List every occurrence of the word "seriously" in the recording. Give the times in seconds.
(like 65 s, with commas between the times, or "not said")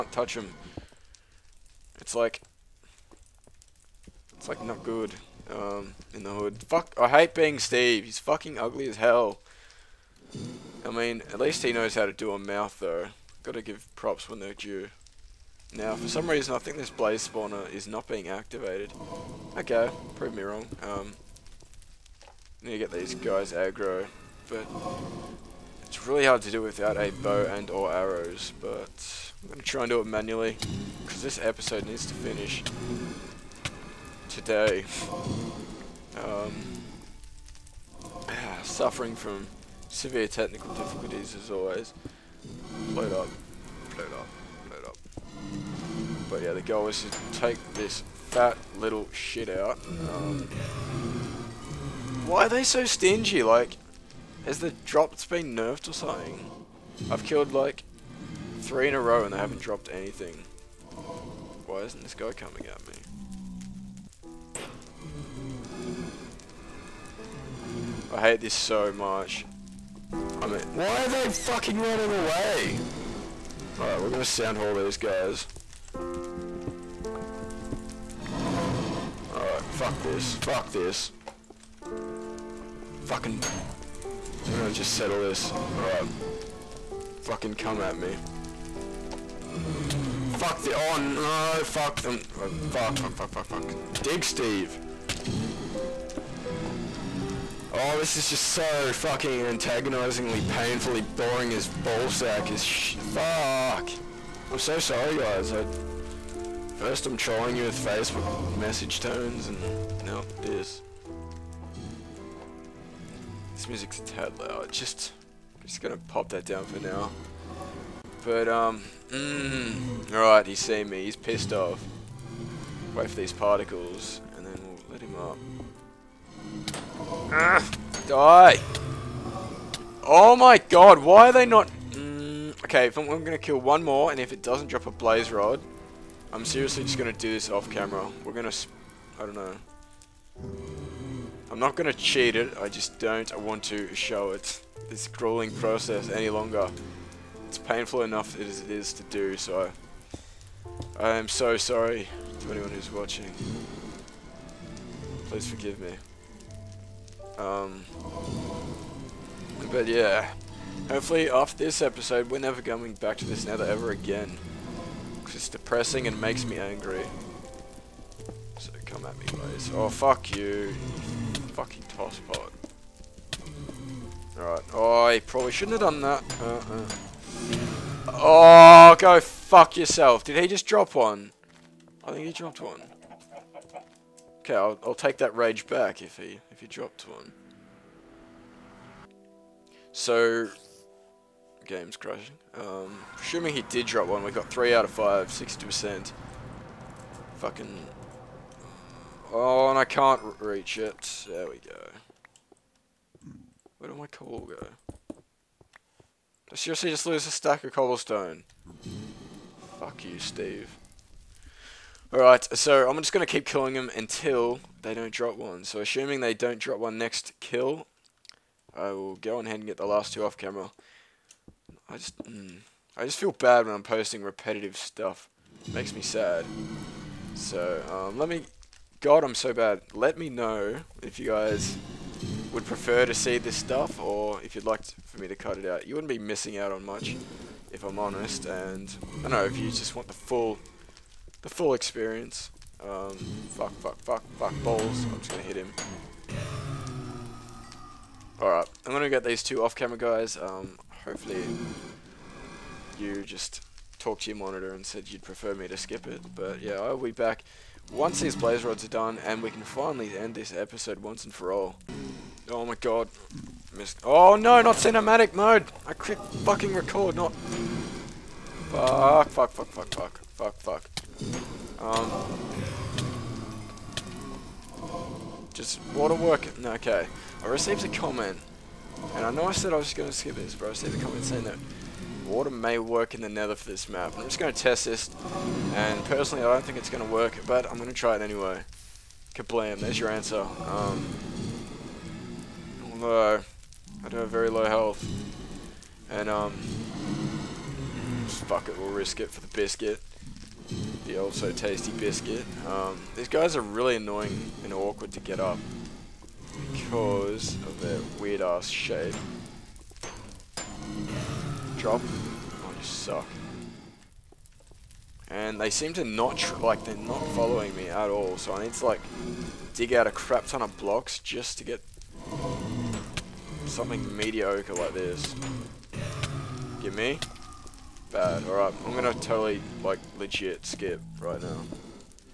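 136 s, 206 s.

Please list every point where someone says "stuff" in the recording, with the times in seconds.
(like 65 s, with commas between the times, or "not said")
224 s, 233 s.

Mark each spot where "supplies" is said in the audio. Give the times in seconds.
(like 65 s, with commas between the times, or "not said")
not said.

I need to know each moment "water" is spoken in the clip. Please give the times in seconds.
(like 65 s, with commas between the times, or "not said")
275 s, 282 s.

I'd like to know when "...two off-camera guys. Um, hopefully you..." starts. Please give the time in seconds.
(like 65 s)
249 s.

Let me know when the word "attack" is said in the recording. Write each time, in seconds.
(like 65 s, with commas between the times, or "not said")
not said.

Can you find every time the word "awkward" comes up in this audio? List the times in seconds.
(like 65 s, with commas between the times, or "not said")
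304 s.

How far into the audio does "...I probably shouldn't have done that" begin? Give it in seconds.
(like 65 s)
175 s.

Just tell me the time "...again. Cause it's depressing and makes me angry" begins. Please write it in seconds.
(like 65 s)
163 s.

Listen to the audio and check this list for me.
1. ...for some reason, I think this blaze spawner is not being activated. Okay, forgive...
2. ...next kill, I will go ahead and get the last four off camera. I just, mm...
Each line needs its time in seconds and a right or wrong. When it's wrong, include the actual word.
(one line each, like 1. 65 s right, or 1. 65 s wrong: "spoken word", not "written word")
1. 15 s wrong: "prove", not "forgive"
2. 216 s wrong: "two", not "four".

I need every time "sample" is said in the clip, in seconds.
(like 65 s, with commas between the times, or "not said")
not said.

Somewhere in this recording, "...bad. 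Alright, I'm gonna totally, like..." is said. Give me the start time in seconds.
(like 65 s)
328 s.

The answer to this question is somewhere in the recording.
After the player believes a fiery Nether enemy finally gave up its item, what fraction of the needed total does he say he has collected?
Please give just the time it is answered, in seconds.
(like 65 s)
194 s.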